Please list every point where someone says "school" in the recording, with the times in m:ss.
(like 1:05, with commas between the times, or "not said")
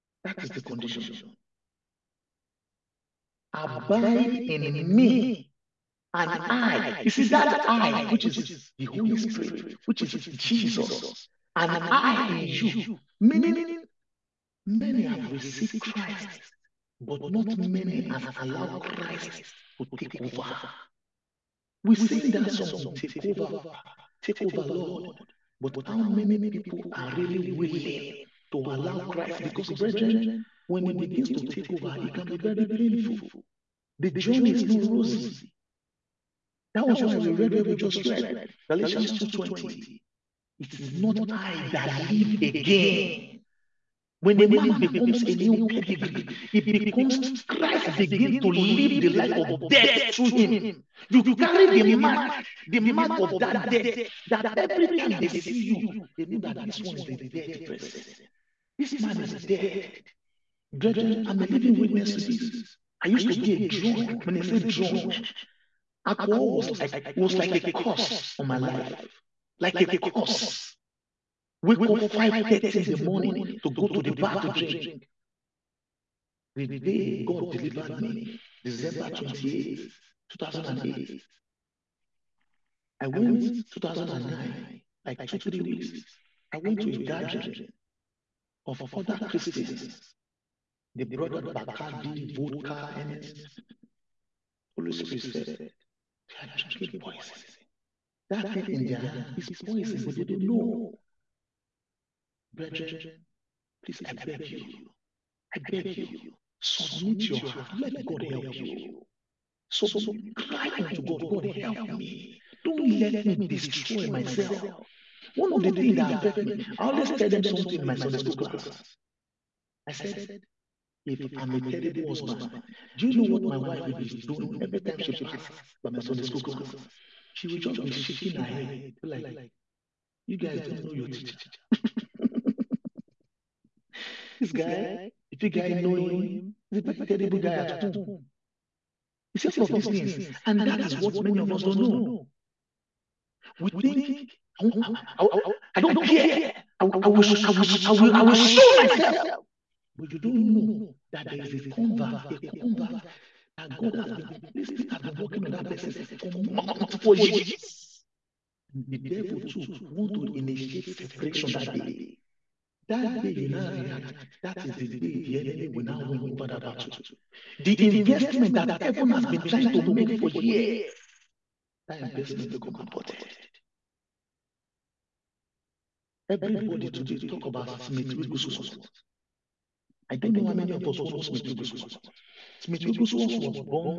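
1:58, 2:06.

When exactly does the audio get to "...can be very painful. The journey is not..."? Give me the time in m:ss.
0:32.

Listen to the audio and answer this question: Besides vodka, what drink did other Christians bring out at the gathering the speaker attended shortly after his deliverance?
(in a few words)
Bacardi.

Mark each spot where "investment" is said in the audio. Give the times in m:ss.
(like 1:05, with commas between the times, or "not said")
2:47, 2:52.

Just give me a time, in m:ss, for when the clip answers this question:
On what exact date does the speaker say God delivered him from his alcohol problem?
1:18.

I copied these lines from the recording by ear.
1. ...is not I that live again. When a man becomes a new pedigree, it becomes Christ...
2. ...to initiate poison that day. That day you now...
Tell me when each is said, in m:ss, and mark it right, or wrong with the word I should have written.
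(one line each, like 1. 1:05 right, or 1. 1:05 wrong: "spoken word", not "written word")
1. 0:40 right
2. 2:40 wrong: "separation", not "poison".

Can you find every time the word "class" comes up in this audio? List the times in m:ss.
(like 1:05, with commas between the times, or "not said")
1:58, 2:06.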